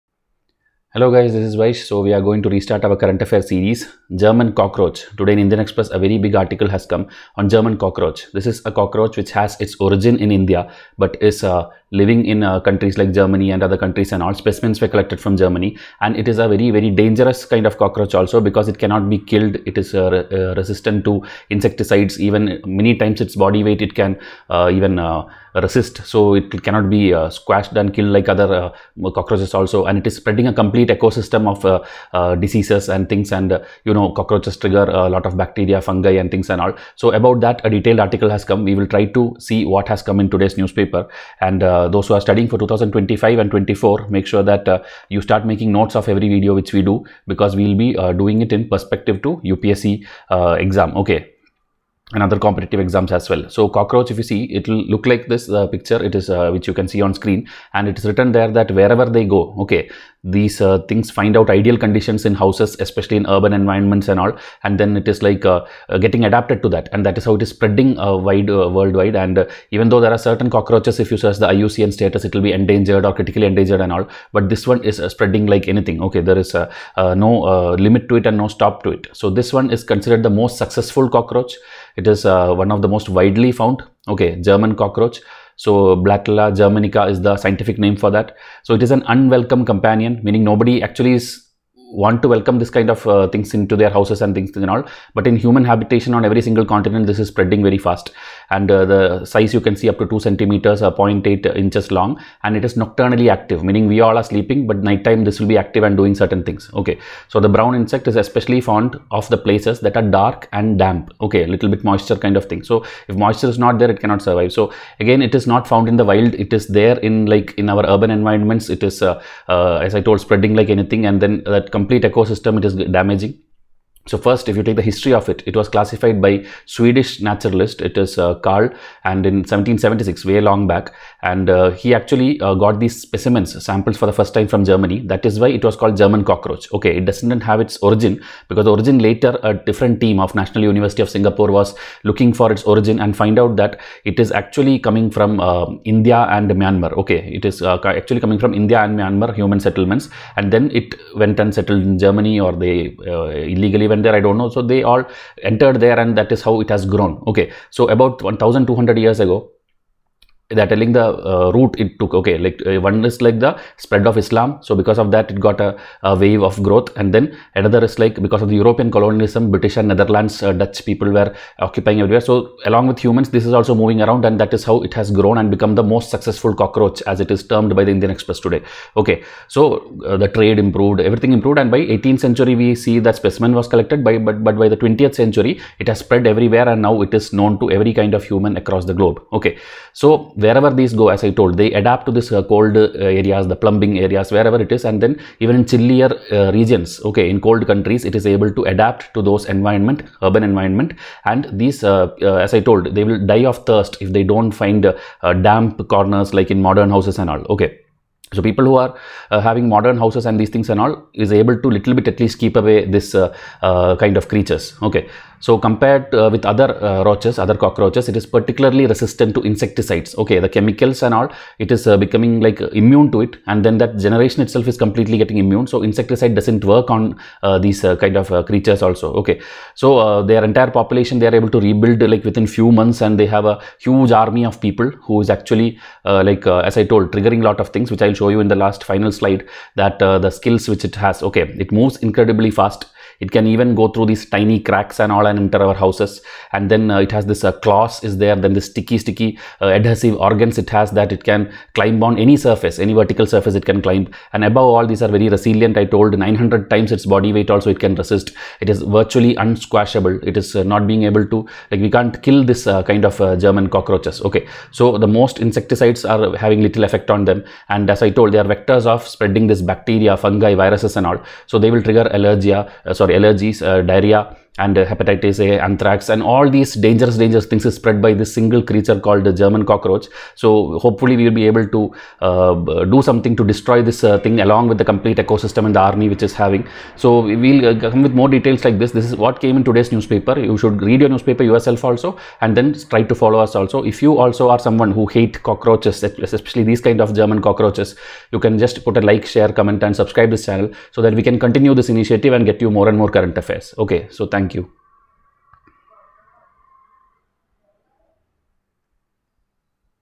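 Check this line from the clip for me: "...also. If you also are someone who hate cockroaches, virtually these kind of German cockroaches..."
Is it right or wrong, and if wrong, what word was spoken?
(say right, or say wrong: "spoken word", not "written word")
wrong: "especially", not "virtually".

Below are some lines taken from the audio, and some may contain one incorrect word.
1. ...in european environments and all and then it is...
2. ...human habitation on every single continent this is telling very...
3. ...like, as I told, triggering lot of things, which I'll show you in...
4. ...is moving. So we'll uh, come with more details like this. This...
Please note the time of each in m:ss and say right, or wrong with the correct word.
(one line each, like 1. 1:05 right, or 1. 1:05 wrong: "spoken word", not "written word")
1. 1:03 wrong: "urban", not "european"
2. 1:35 wrong: "spreading", not "telling"
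3. 3:56 right
4. 4:46 wrong: "having", not "moving".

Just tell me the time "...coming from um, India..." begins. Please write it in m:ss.
2:24.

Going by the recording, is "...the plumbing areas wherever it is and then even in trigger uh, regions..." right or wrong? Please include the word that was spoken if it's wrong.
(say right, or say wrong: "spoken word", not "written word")
wrong: "chillier", not "trigger".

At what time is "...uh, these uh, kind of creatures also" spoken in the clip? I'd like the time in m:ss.
3:47.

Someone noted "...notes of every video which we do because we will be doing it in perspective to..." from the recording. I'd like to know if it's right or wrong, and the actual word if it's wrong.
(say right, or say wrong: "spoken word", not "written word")
right.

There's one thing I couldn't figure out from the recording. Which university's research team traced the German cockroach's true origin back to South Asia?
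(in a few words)
National University of Singapore.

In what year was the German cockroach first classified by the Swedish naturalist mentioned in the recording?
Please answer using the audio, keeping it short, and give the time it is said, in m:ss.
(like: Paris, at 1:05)
1776, at 2:09.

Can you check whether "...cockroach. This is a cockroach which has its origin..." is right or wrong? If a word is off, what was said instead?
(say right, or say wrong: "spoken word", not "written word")
right.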